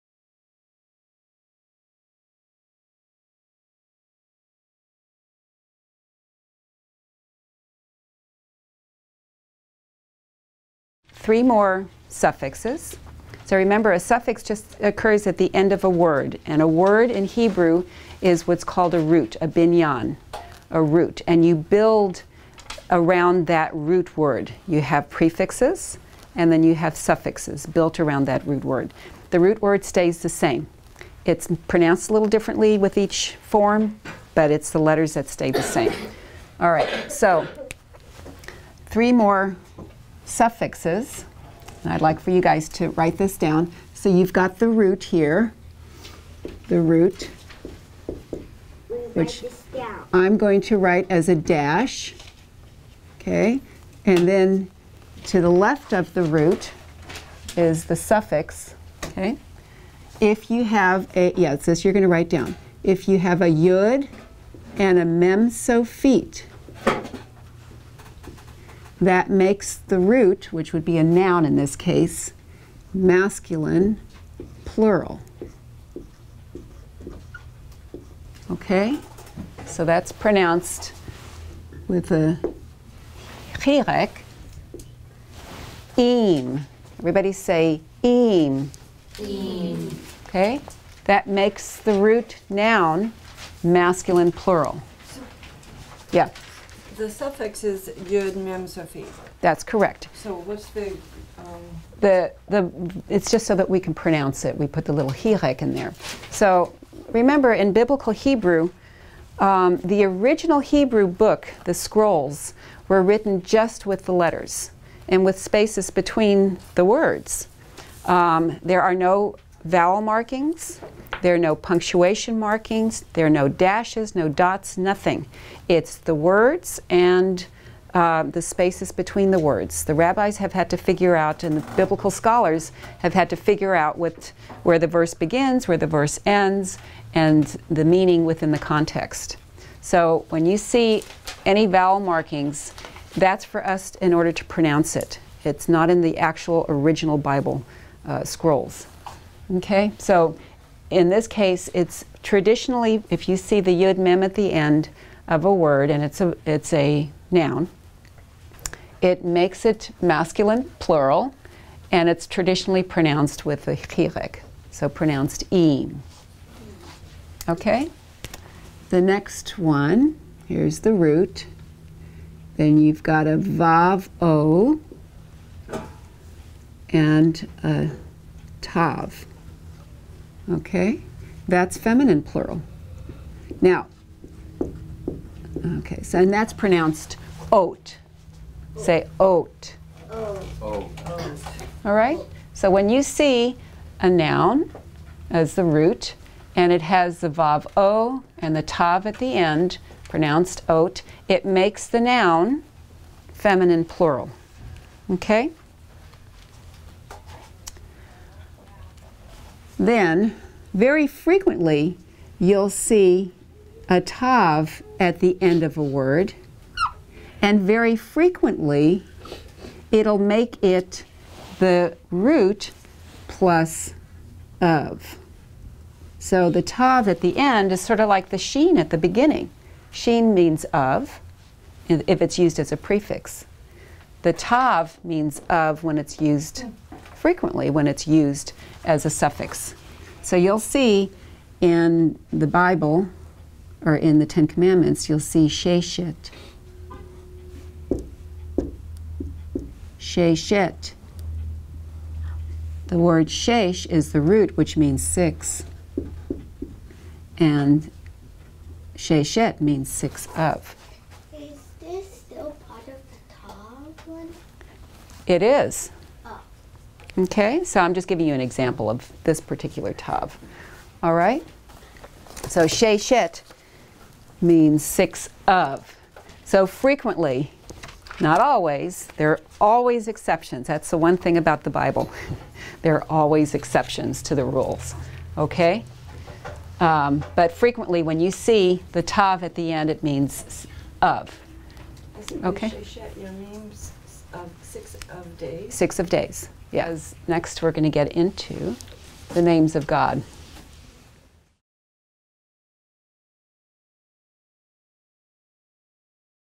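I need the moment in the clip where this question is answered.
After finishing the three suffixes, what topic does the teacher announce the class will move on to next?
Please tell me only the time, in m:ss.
4:59.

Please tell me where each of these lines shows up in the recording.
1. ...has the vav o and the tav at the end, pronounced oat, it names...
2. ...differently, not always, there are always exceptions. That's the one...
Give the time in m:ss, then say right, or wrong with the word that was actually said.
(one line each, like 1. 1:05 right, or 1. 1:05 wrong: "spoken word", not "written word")
1. 3:16 wrong: "makes", not "names"
2. 4:36 wrong: "frequently", not "differently".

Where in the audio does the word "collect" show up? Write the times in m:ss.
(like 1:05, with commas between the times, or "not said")
not said.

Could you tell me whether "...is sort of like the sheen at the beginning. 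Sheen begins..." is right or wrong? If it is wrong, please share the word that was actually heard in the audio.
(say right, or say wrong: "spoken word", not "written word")
wrong: "means", not "begins".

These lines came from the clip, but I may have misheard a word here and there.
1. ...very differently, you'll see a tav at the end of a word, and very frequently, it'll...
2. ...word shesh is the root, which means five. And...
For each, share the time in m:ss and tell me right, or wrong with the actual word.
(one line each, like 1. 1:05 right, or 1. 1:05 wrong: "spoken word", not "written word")
1. 3:30 wrong: "frequently", not "differently"
2. 4:12 wrong: "six", not "five".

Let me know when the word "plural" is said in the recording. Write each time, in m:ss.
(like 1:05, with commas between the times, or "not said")
1:14, 1:34, 2:40, 3:02, 3:23.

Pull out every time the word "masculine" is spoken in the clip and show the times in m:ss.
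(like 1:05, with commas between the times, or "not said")
1:12, 1:33, 2:40.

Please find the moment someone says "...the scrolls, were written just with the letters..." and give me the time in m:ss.
1:51.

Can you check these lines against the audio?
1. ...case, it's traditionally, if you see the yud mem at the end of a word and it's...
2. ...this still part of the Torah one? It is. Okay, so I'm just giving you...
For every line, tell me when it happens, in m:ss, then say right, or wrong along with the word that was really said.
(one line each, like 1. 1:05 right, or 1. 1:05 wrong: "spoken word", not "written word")
1. 2:31 right
2. 4:21 right.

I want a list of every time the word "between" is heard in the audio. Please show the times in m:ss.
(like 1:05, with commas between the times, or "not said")
1:55, 2:08.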